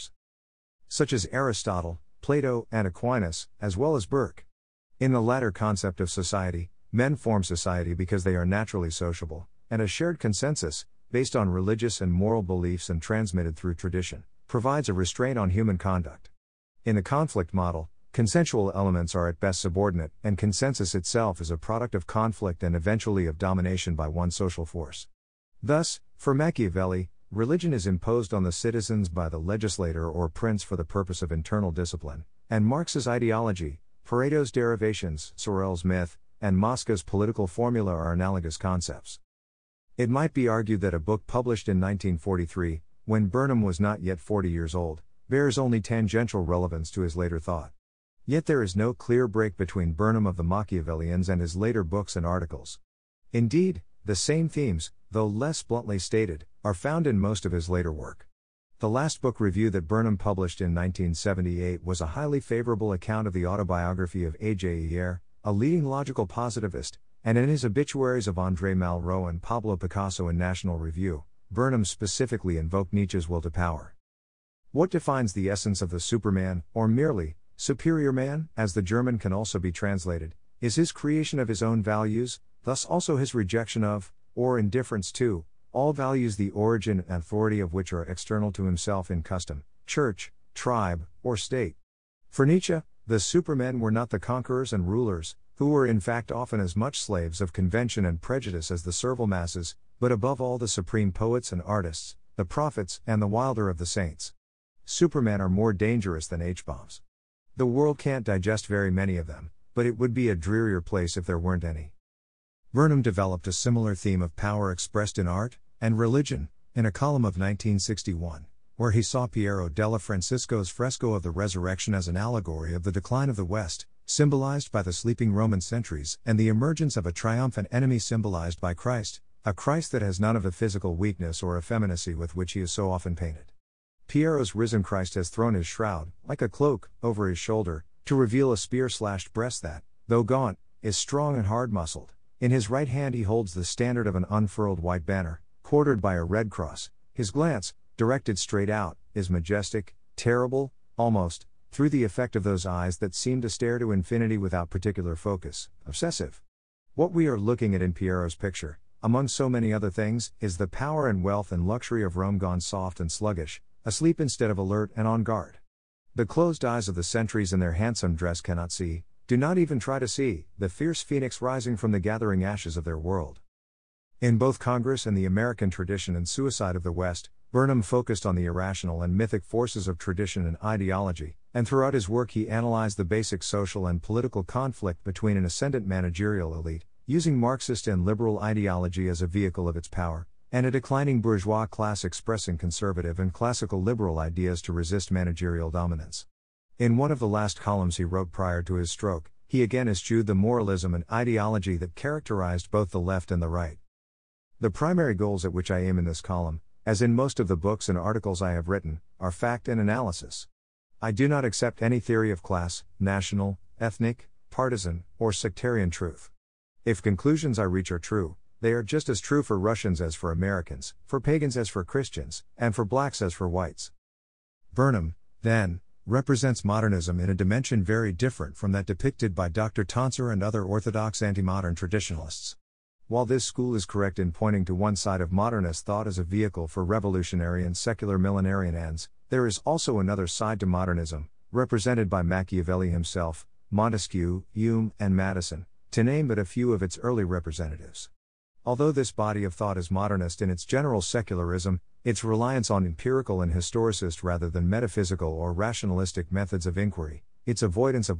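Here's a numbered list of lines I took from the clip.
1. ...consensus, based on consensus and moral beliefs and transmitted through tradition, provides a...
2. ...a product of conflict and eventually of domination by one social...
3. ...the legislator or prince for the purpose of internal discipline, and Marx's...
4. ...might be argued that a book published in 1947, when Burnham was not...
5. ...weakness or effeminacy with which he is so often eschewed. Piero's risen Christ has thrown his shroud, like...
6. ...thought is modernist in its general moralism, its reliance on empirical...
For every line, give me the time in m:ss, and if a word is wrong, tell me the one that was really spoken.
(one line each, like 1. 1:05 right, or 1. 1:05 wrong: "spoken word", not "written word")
1. 0:10 wrong: "religious", not "consensus"
2. 0:21 right
3. 0:29 right
4. 0:40 wrong: "1943", not "1947"
5. 2:10 wrong: "painted", not "eschewed"
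6. 4:09 wrong: "secularism", not "moralism".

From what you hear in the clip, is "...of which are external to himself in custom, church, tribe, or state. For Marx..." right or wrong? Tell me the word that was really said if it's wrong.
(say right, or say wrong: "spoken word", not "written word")
wrong: "Nietzsche", not "Marx".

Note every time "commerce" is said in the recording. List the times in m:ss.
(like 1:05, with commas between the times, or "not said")
not said.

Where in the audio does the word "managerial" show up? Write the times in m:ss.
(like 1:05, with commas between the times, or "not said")
3:05, 3:15.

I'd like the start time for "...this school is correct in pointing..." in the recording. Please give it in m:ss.
3:53.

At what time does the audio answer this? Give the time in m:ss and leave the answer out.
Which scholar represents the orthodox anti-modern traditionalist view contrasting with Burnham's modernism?
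3:49.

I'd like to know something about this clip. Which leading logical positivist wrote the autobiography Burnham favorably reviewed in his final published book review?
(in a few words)
A.J. Ayer.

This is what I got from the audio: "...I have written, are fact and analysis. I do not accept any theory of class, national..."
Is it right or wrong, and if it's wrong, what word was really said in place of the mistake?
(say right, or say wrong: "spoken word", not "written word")
right.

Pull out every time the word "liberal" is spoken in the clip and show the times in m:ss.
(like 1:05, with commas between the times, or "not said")
3:08, 3:13.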